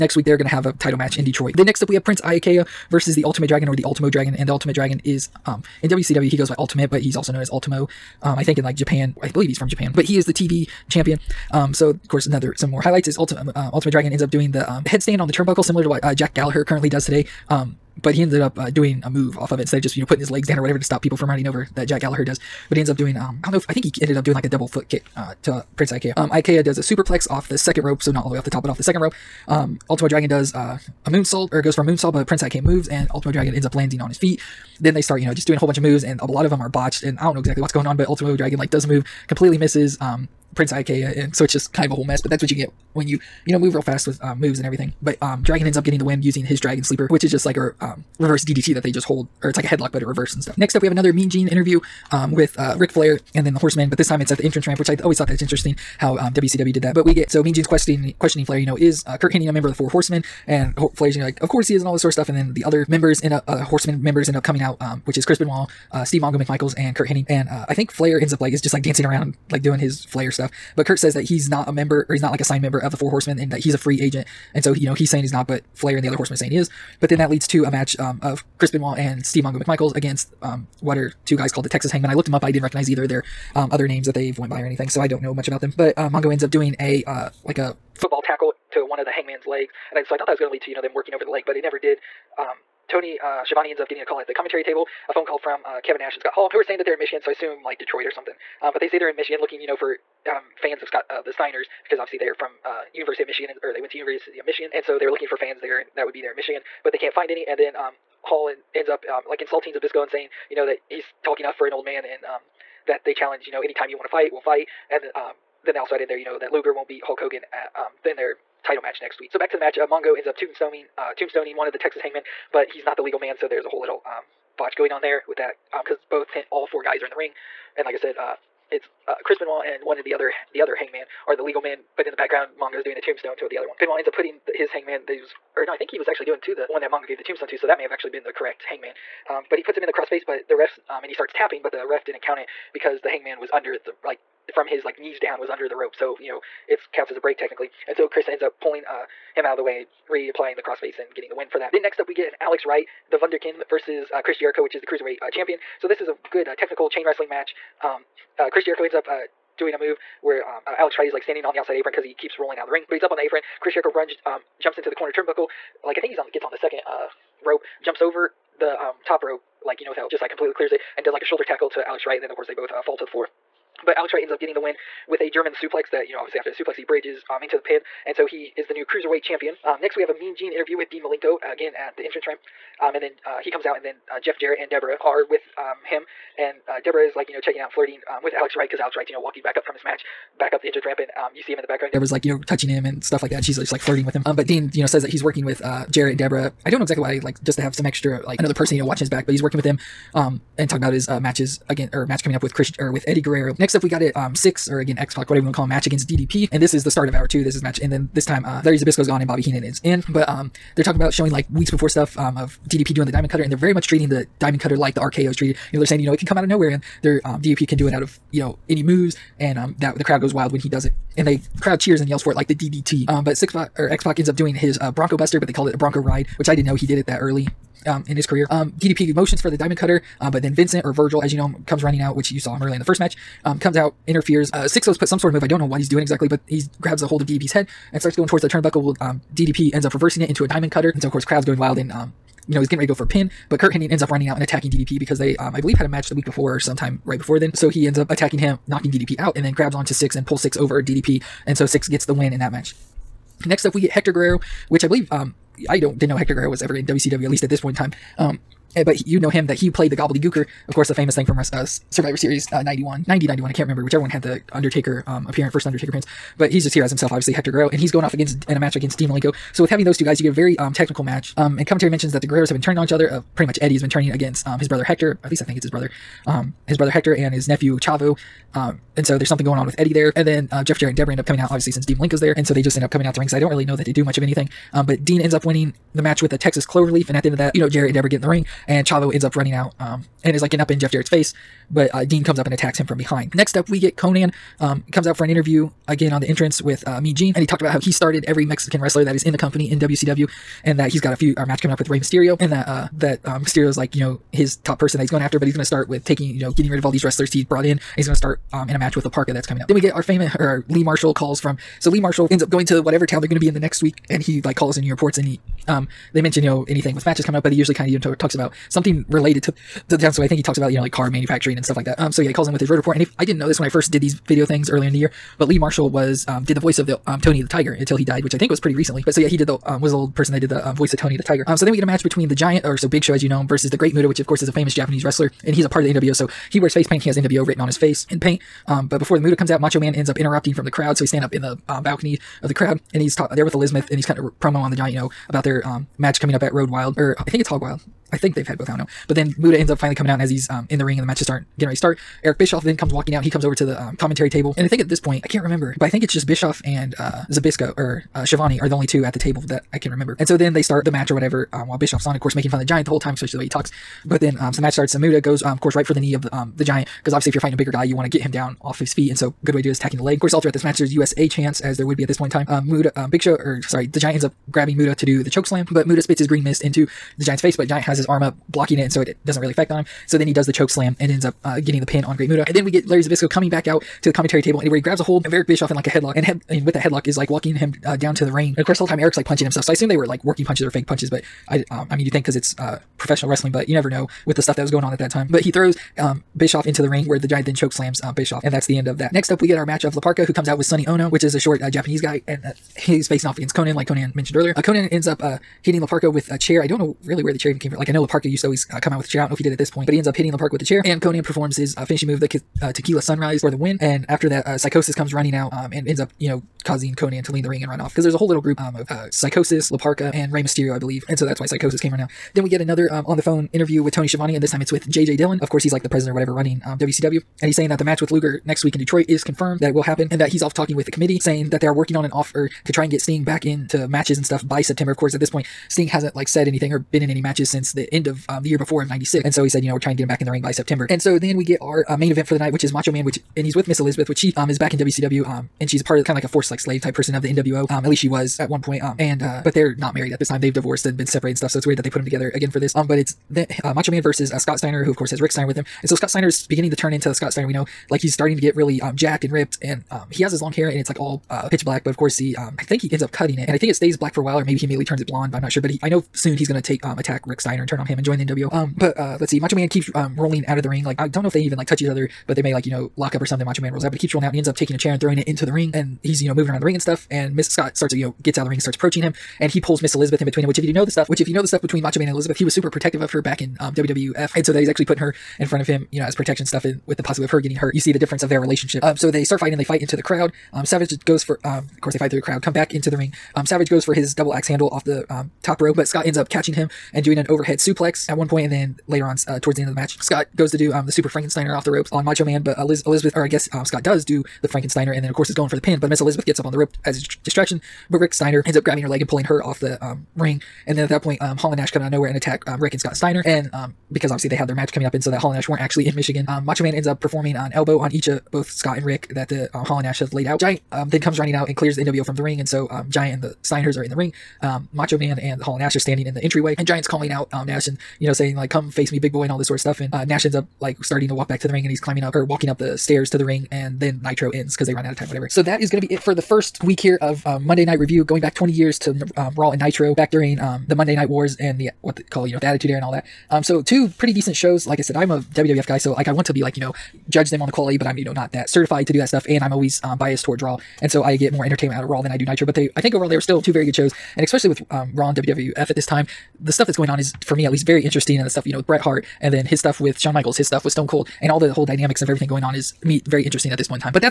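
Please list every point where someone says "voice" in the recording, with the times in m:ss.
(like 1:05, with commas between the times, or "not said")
5:26, 5:30.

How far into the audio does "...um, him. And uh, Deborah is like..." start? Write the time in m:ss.
3:05.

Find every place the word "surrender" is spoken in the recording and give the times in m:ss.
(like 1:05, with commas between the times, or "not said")
not said.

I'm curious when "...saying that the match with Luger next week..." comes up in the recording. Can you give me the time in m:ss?
7:07.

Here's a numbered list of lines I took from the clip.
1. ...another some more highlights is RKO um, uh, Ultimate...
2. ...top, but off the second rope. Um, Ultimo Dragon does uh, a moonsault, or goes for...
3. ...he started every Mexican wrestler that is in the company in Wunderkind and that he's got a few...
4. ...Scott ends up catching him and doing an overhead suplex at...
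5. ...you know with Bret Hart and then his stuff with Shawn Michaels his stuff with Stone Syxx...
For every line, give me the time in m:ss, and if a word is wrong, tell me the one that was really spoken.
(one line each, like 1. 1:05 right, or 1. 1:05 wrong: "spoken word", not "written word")
1. 0:12 wrong: "Ultimate", not "RKO"
2. 0:28 right
3. 4:57 wrong: "WCW", not "Wunderkind"
4. 8:15 right
5. 9:18 wrong: "Cold", not "Syxx".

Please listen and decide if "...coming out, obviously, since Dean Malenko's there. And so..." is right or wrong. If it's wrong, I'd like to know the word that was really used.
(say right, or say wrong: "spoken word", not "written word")
right.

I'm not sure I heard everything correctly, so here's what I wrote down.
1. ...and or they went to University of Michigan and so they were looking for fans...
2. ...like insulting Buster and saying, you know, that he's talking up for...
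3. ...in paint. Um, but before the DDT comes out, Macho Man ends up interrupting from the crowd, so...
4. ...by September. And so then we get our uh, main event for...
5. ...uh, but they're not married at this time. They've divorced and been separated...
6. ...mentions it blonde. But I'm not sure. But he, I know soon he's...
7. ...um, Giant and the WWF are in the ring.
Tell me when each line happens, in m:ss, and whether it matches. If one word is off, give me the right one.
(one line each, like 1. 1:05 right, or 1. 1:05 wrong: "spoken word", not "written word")
1. 1:43 right
2. 1:49 wrong: "Zbyszko", not "Buster"
3. 5:38 wrong: "Muta", not "DDT"
4. 7:20 right
5. 7:29 right
6. 7:44 wrong: "turns", not "mentions"
7. 8:42 wrong: "Steiners", not "WWF".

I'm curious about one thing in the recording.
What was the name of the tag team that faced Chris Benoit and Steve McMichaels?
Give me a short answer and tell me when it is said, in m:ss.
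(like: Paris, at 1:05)
Texas Hangmen, at 1:21.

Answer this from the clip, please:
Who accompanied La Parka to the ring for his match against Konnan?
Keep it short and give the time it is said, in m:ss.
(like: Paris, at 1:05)
Sonny Onoo, at 6:40.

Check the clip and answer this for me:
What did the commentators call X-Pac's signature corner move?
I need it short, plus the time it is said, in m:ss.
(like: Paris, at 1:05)
Bronco Ride, at 3:45.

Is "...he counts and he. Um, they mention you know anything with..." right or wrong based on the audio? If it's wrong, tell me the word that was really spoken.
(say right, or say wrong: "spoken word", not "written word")
wrong: "reports", not "counts".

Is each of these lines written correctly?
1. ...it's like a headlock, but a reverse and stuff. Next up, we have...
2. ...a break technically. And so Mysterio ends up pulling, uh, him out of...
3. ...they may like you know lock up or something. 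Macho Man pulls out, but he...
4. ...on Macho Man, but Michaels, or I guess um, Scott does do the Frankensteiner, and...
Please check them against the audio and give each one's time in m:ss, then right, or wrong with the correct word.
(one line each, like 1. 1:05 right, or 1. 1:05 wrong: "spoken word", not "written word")
1. 0:49 right
2. 2:27 wrong: "Chris", not "Mysterio"
3. 7:52 wrong: "rolls", not "pulls"
4. 8:21 wrong: "Elizabeth", not "Michaels".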